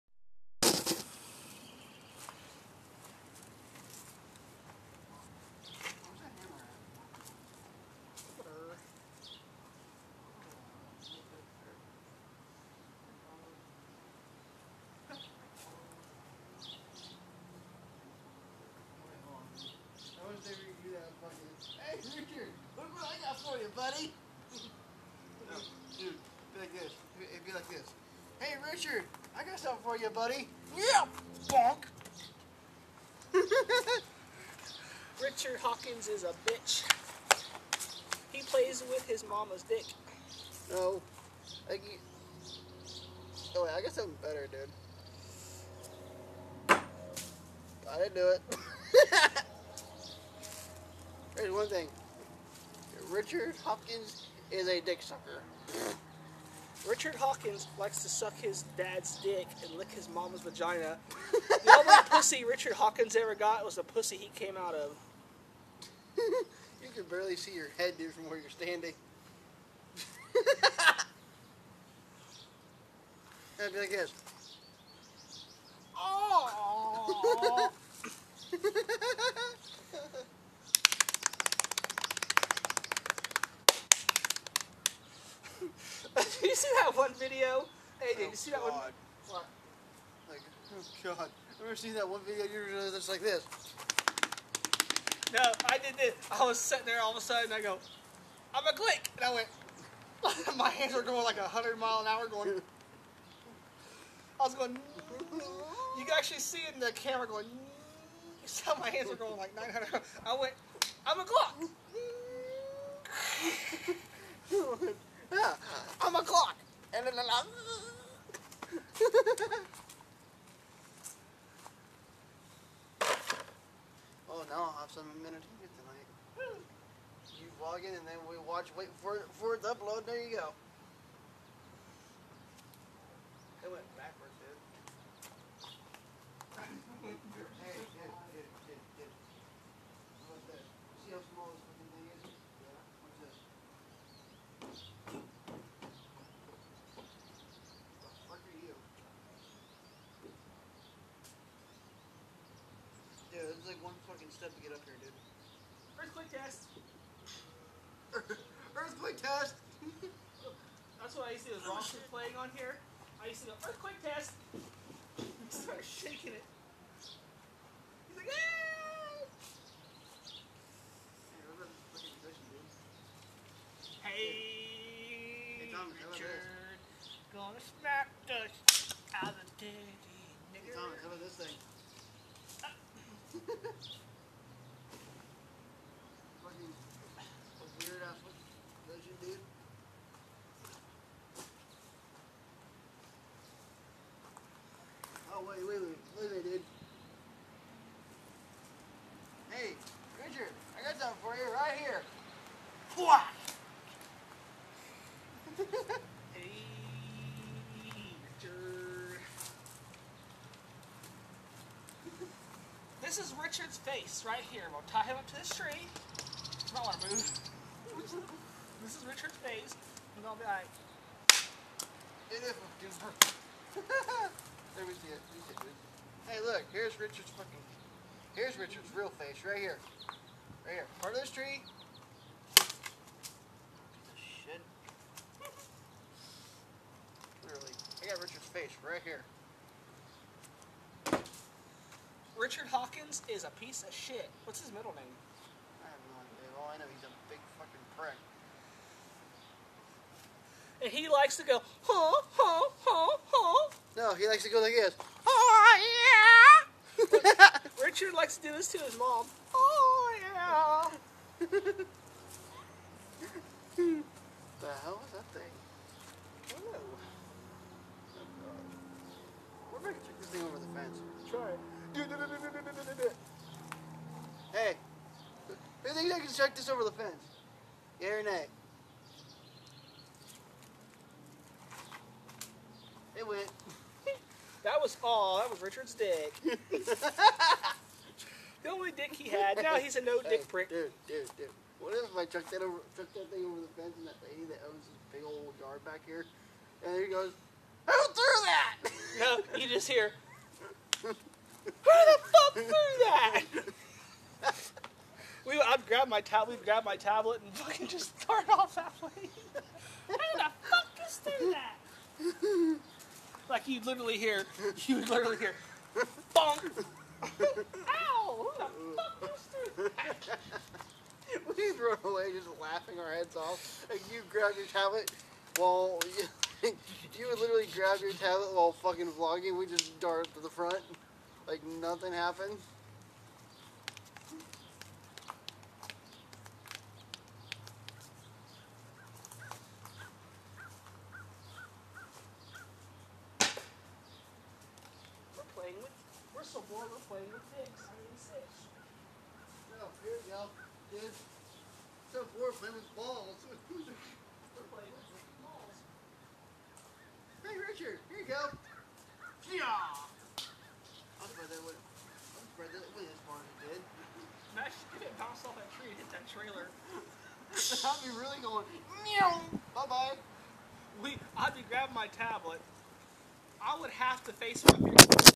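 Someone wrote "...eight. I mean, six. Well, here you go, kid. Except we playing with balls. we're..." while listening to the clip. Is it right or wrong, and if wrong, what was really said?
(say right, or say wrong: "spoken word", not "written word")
wrong: "six", not "eight".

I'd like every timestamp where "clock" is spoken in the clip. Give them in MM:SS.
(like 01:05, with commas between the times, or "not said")
01:51, 01:56.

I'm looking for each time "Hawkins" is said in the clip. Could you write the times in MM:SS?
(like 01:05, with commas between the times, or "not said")
00:35, 00:57, 01:02, 04:02.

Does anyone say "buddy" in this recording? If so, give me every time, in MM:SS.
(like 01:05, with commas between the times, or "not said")
00:23, 00:30.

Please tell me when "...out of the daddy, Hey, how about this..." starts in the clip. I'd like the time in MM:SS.
02:59.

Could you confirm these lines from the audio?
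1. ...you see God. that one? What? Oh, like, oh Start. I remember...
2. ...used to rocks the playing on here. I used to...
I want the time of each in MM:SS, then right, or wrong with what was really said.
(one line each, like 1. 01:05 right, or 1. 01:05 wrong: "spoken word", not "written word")
1. 01:28 wrong: "God", not "Start"
2. 02:41 right.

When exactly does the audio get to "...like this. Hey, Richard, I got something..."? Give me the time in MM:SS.
00:27.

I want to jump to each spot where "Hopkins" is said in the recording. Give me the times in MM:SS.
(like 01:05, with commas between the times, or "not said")
00:53.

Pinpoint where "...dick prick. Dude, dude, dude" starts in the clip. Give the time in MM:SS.
04:50.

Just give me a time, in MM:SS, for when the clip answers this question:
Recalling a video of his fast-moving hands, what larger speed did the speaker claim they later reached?
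01:49.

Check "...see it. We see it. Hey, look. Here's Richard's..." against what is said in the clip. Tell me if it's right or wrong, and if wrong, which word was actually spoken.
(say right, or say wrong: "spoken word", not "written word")
right.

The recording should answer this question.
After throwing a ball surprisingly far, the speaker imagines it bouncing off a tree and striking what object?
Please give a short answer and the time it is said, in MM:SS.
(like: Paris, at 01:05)
Trailer, at 06:06.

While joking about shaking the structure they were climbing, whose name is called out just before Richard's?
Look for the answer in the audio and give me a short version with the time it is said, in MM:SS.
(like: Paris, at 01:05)
Tom, at 02:55.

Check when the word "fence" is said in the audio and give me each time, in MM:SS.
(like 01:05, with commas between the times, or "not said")
04:36, 04:53.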